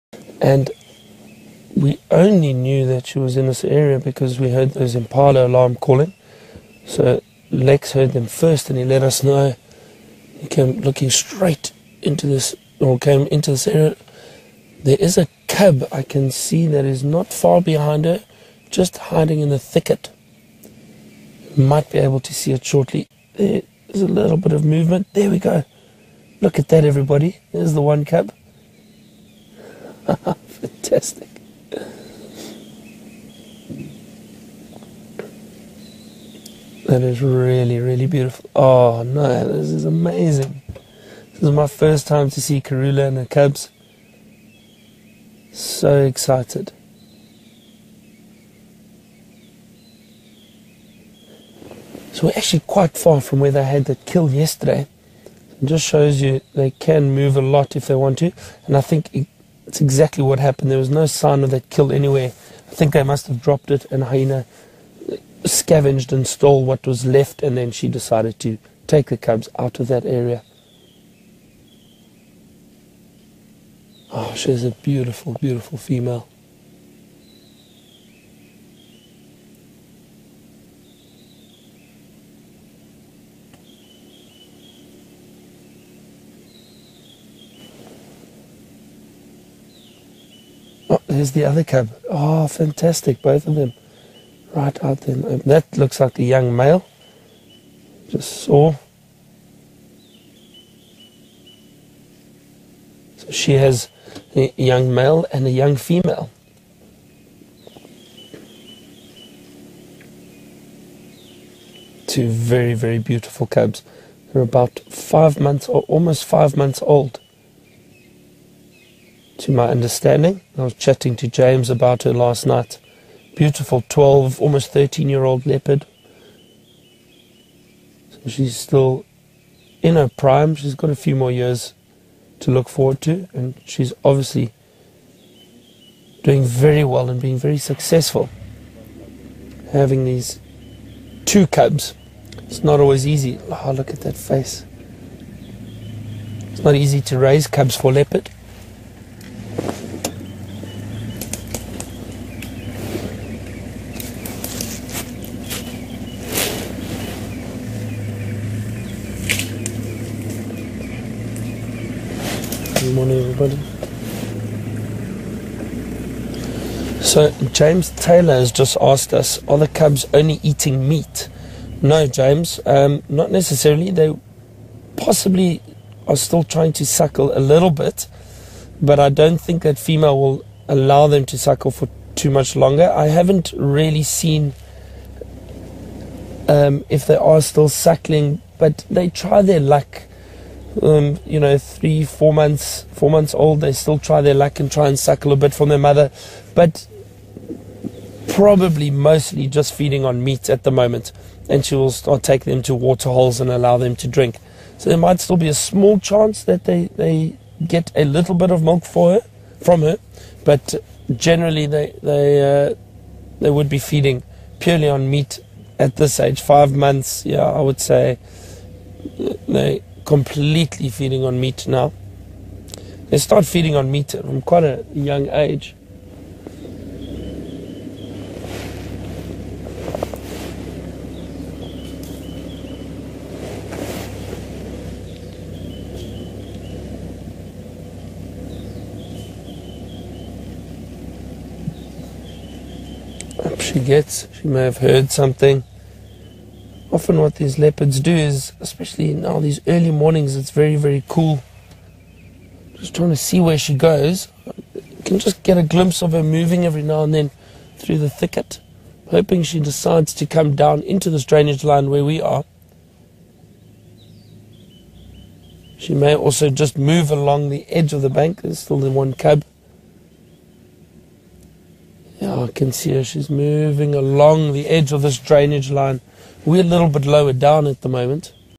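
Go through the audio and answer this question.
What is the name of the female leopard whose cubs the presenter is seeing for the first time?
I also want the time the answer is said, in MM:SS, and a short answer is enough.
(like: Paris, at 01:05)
Karula, at 00:42.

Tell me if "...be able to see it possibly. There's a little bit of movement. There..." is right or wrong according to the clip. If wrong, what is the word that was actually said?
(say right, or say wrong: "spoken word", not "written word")
wrong: "shortly", not "possibly".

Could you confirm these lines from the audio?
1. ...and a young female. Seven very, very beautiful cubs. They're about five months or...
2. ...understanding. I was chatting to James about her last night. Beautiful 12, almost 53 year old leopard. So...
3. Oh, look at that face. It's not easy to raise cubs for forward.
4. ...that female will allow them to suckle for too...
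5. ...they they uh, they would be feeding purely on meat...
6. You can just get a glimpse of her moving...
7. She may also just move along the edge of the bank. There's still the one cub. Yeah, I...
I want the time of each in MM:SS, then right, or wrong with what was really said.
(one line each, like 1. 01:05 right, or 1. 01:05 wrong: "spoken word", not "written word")
1. 01:45 wrong: "Two", not "Seven"
2. 01:59 wrong: "13", not "53"
3. 02:23 wrong: "leopard", not "forward"
4. 02:59 right
5. 03:31 right
6. 04:14 right
7. 04:25 right.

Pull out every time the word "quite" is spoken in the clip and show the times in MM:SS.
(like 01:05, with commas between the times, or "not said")
00:52, 03:44.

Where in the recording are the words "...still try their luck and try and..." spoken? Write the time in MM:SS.
03:13.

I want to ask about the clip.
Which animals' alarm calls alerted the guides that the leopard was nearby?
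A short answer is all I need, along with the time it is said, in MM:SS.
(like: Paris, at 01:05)
Impala, at 00:04.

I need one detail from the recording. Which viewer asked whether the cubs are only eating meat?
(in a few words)
James Taylor.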